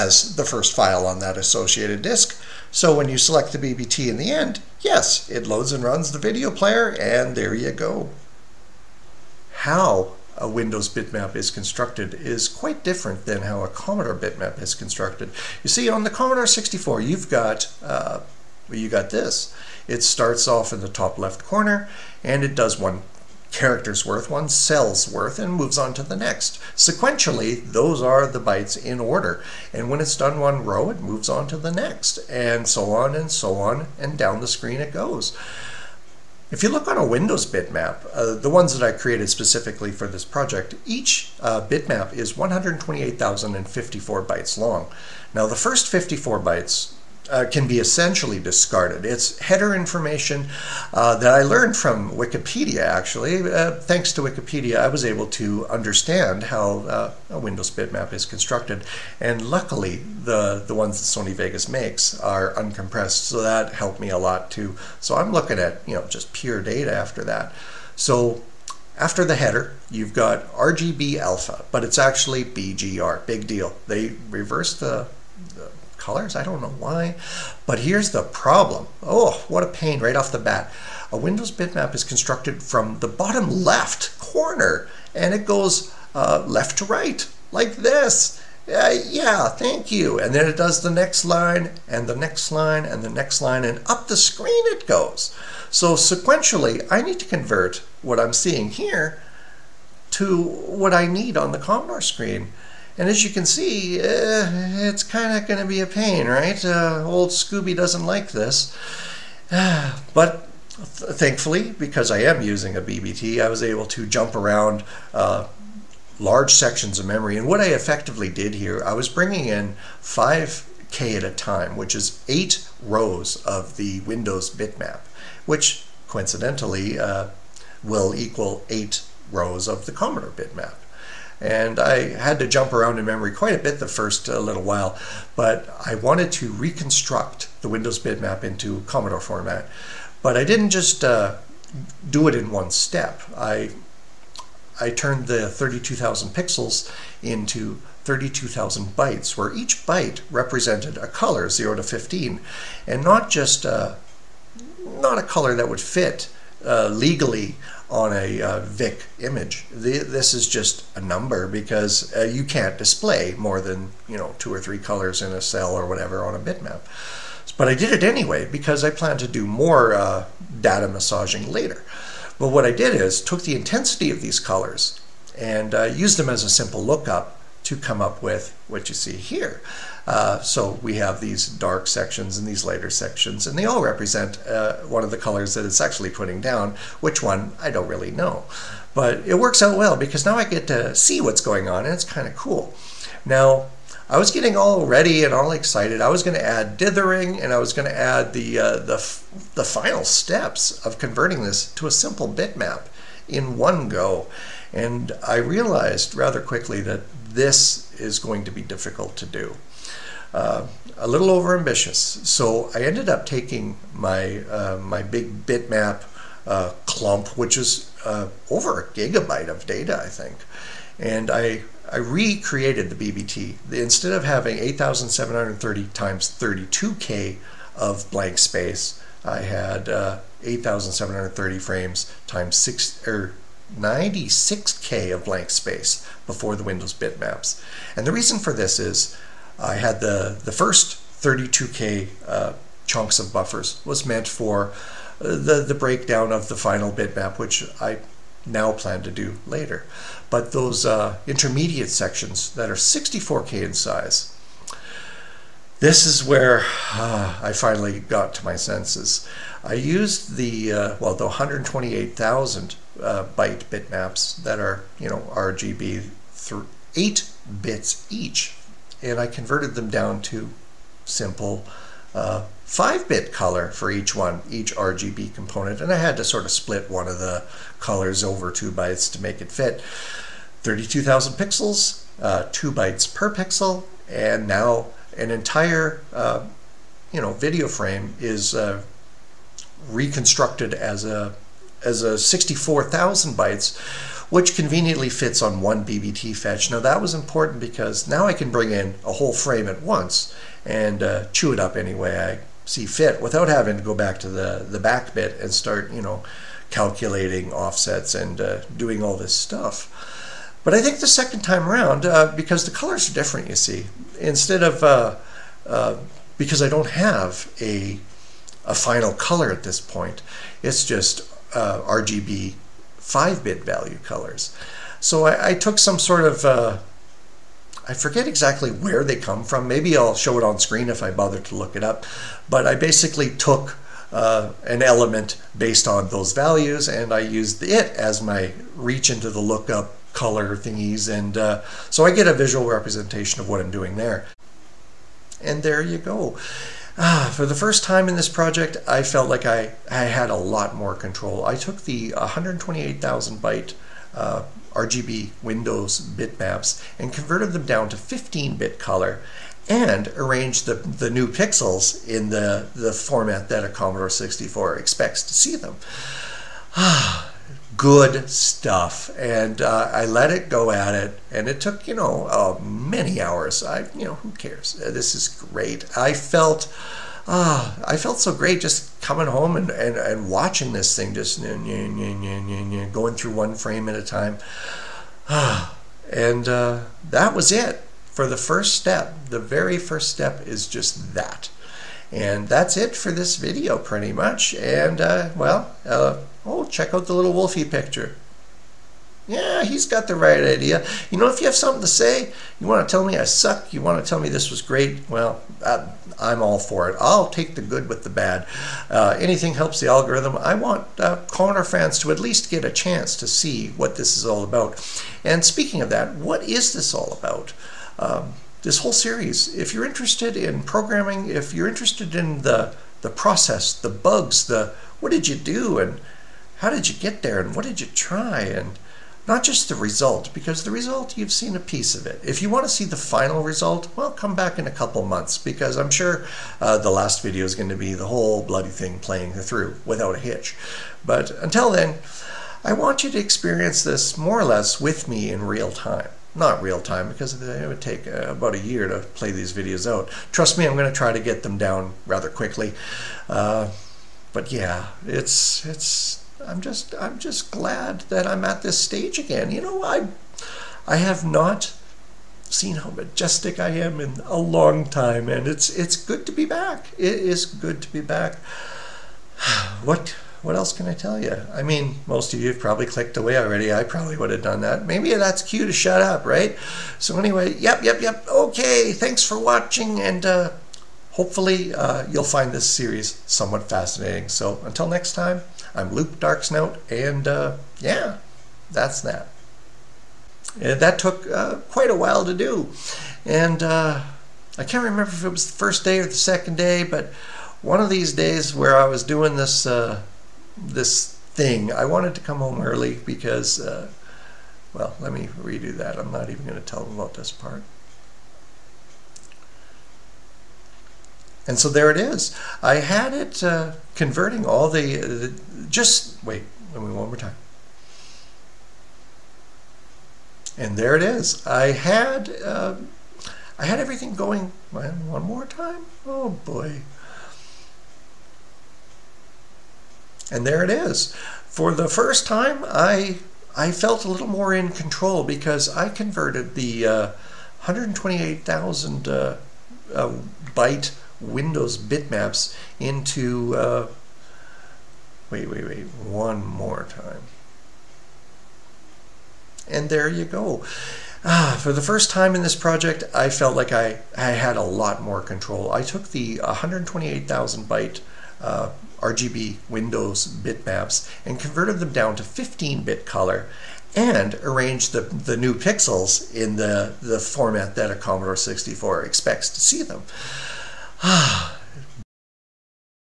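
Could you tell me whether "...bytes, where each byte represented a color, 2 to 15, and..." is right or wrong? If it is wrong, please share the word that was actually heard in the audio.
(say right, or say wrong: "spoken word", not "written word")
wrong: "0", not "2".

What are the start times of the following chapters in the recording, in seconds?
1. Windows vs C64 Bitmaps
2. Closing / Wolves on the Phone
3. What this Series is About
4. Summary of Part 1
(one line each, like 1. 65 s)
1. 8 s
2. 489 s
3. 409 s
4. 344 s.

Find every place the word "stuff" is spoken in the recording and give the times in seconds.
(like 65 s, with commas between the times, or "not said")
309 s, 368 s.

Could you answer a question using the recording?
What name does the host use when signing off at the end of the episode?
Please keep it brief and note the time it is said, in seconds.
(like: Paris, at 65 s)
Lupe Darksnout, at 485 s.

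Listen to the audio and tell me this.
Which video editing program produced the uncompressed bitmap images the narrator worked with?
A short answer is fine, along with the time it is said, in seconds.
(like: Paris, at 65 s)
Sony Vegas, at 61 s.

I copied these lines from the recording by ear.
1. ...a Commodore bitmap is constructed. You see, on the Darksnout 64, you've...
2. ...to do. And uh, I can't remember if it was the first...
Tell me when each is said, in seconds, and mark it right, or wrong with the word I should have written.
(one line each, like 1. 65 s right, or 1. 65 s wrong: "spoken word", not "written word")
1. 13 s wrong: "Commodore", not "Darksnout"
2. 492 s right.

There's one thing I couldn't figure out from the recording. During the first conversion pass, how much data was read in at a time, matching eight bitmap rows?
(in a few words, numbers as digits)
5K.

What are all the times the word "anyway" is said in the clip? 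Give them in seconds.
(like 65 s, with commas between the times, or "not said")
168 s, 477 s.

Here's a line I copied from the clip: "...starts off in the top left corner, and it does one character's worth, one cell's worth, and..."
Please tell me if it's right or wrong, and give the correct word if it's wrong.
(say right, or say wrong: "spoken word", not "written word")
right.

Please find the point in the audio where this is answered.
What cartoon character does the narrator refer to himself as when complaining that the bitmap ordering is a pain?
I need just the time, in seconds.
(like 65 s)
107 s.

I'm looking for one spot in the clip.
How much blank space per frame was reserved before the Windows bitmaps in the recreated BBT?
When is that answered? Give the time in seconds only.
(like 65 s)
233 s.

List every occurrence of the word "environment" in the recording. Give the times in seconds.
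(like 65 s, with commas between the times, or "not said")
not said.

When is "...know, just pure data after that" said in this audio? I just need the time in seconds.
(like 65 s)
65 s.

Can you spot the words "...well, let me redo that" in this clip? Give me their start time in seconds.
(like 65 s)
504 s.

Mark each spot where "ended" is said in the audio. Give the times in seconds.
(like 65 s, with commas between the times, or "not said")
212 s.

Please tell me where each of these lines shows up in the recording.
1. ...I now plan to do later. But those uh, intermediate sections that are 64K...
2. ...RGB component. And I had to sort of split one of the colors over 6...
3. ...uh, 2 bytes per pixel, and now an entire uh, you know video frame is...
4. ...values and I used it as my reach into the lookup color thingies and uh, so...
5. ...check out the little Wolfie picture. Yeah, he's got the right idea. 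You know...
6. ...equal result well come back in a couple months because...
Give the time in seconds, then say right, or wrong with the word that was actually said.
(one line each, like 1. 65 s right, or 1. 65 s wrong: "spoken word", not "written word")
1. 247 s right
2. 274 s wrong: "2", not "6"
3. 282 s right
4. 336 s right
5. 396 s right
6. 432 s wrong: "final", not "equal".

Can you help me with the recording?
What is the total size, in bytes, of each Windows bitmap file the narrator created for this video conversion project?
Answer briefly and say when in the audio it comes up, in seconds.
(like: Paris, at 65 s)
128,054, at 42 s.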